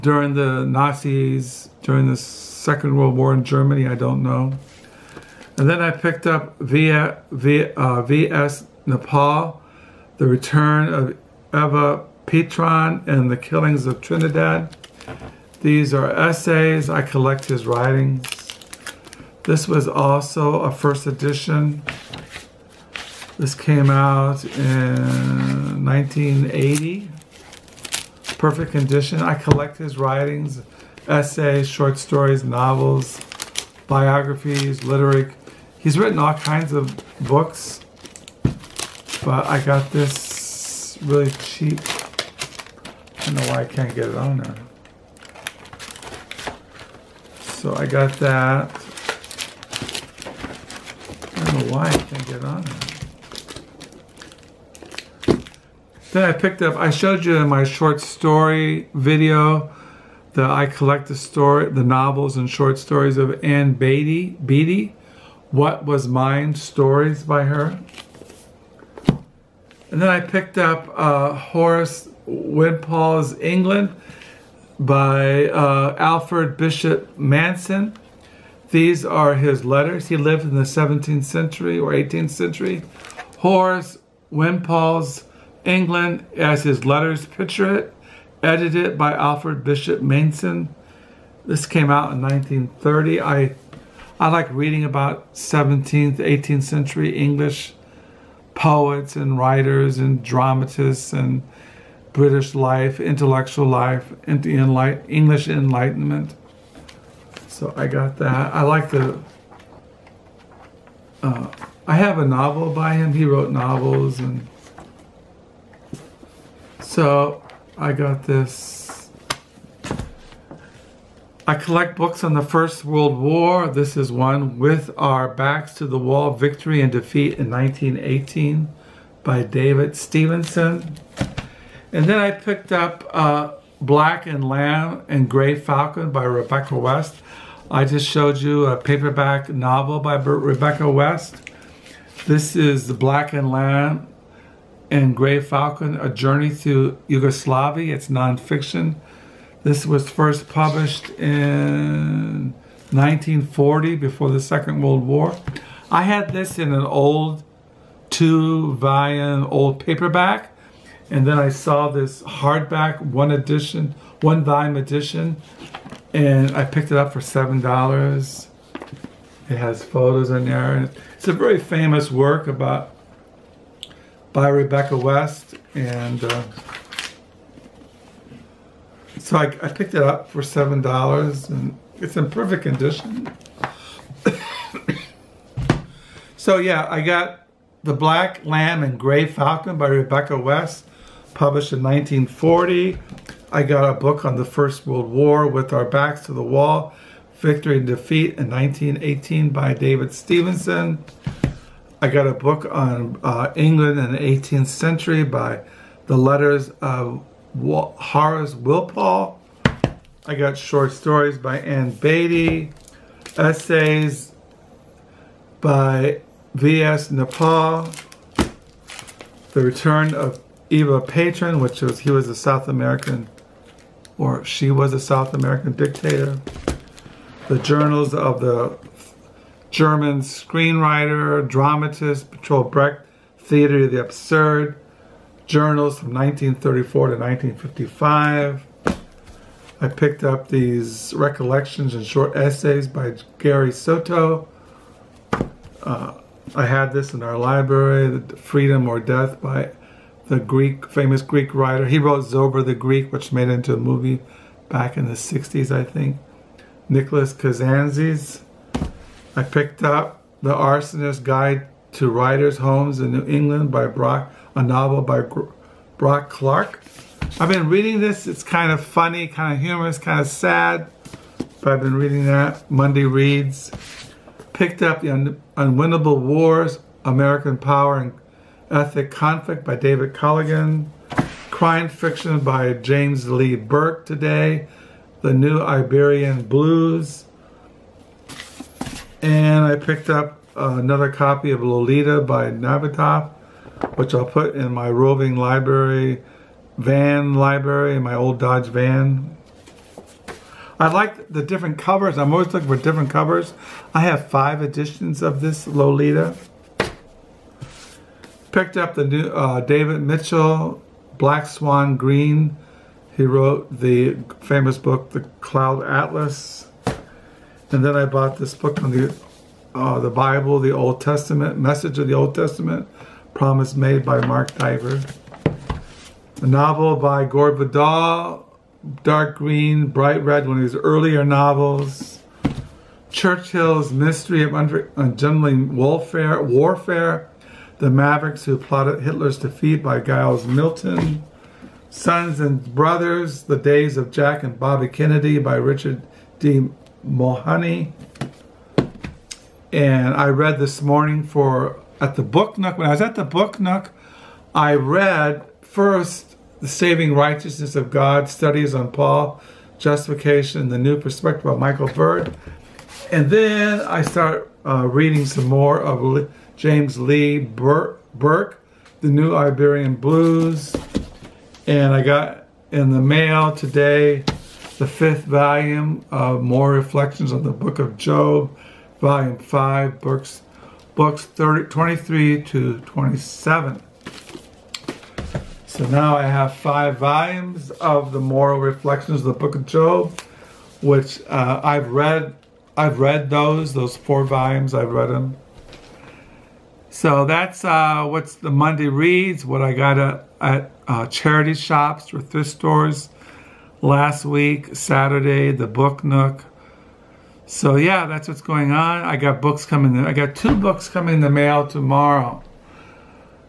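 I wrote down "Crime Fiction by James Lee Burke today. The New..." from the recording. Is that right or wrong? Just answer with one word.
right.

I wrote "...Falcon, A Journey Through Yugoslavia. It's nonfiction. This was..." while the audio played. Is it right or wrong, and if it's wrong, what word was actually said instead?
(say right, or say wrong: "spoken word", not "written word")
right.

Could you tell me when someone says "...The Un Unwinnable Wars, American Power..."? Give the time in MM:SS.
04:35.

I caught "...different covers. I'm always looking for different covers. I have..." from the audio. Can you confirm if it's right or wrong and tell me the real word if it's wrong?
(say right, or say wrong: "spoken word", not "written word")
right.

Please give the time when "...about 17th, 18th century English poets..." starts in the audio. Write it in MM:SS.
01:34.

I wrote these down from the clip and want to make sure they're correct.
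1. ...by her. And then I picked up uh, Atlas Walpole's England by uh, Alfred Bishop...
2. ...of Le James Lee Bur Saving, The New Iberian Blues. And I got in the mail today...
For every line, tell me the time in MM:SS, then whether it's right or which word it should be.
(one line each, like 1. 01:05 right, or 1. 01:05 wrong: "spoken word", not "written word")
1. 01:07 wrong: "Horace", not "Atlas"
2. 06:05 wrong: "Burke", not "Saving".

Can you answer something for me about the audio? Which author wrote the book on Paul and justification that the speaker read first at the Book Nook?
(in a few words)
Michael Bird.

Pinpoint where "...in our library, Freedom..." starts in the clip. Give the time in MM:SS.
04:07.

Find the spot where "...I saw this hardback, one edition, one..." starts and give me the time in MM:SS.
02:41.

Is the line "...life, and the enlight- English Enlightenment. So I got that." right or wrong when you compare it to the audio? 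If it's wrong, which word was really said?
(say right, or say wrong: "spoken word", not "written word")
right.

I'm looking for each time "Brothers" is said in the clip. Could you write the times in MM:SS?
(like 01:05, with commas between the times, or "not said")
05:42.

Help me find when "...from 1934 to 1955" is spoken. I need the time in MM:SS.
03:55.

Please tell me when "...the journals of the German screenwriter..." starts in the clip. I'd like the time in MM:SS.
03:47.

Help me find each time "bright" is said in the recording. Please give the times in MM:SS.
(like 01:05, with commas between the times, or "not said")
05:29.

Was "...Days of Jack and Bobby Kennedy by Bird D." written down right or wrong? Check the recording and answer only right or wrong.
wrong.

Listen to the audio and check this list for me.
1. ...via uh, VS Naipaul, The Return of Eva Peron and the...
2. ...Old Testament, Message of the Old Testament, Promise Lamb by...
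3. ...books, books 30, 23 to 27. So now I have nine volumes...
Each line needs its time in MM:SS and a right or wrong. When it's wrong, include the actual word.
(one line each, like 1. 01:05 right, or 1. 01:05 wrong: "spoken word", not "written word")
1. 00:07 right
2. 05:20 wrong: "Made", not "Lamb"
3. 06:20 wrong: "five", not "nine".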